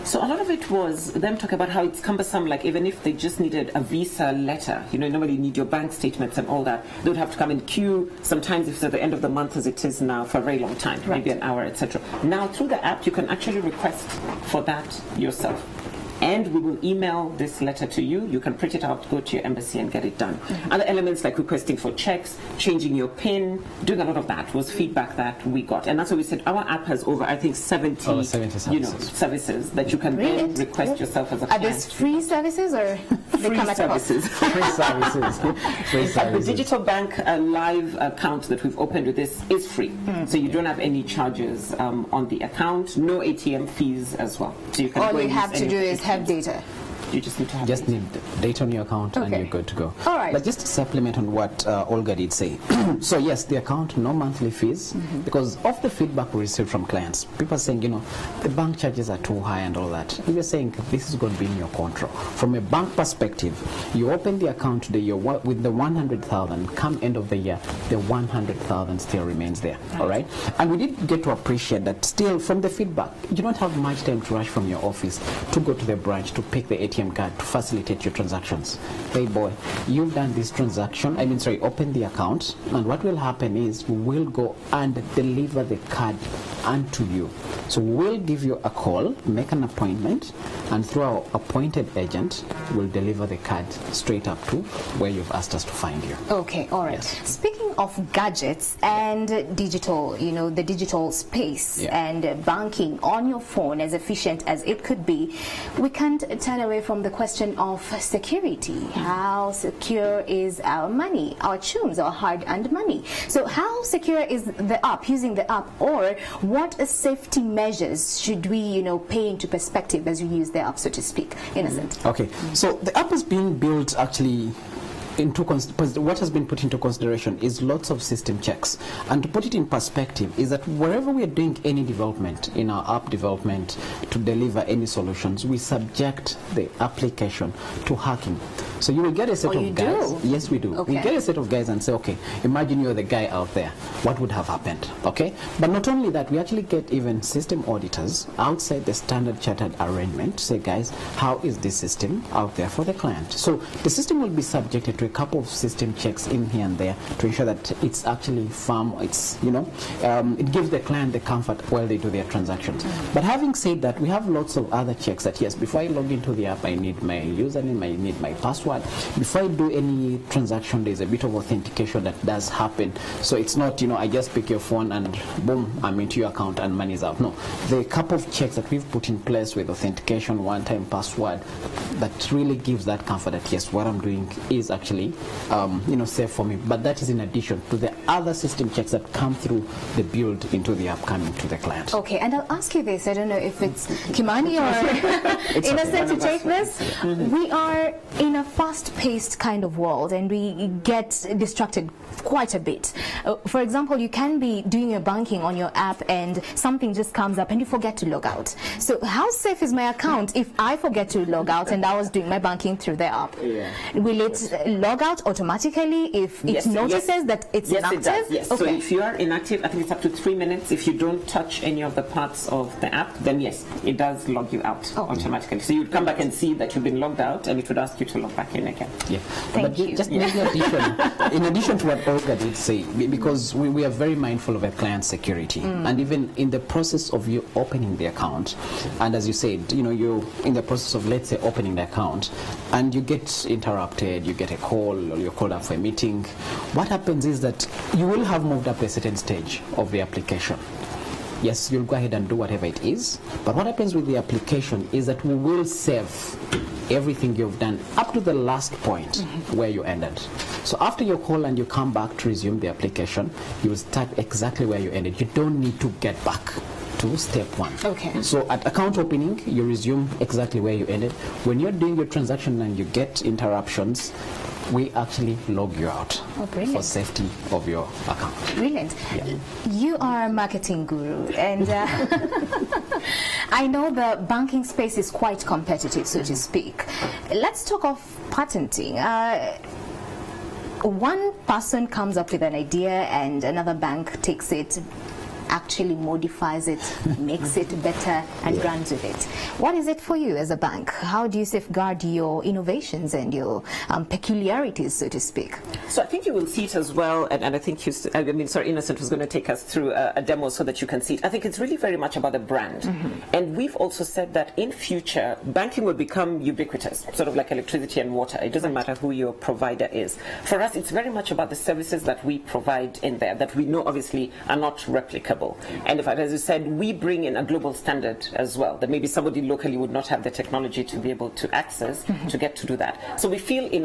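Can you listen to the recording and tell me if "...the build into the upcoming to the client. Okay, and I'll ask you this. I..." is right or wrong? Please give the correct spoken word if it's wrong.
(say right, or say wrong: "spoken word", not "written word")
right.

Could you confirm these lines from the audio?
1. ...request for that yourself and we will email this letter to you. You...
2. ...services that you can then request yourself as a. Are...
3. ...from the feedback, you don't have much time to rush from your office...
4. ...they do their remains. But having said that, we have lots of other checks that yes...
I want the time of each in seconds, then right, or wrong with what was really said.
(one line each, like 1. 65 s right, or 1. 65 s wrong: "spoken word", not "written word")
1. 13 s right
2. 28 s right
3. 72 s right
4. 161 s wrong: "transactions", not "remains".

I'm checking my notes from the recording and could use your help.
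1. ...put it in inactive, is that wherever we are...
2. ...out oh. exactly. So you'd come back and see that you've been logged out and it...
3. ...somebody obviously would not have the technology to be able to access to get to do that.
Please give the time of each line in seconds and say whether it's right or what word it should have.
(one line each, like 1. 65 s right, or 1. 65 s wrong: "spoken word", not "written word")
1. 129 s wrong: "perspective", not "inactive"
2. 224 s wrong: "automatically", not "exactly"
3. 329 s wrong: "locally", not "obviously".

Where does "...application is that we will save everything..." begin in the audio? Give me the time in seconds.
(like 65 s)
254 s.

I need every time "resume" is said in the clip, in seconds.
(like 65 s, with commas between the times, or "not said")
262 s, 269 s.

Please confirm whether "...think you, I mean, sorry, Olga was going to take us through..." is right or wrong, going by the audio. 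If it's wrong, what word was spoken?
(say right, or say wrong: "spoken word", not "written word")
wrong: "Innocent", not "Olga".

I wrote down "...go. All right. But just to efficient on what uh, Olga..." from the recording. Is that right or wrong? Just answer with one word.
wrong.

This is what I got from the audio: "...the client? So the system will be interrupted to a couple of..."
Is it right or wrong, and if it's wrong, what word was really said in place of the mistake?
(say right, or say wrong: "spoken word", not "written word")
wrong: "subjected", not "interrupted".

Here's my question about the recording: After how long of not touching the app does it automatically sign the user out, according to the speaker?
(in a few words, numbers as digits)
3 minutes.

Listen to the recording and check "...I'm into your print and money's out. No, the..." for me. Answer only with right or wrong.
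wrong.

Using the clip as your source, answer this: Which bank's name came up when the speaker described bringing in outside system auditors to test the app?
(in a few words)
Standard Chartered.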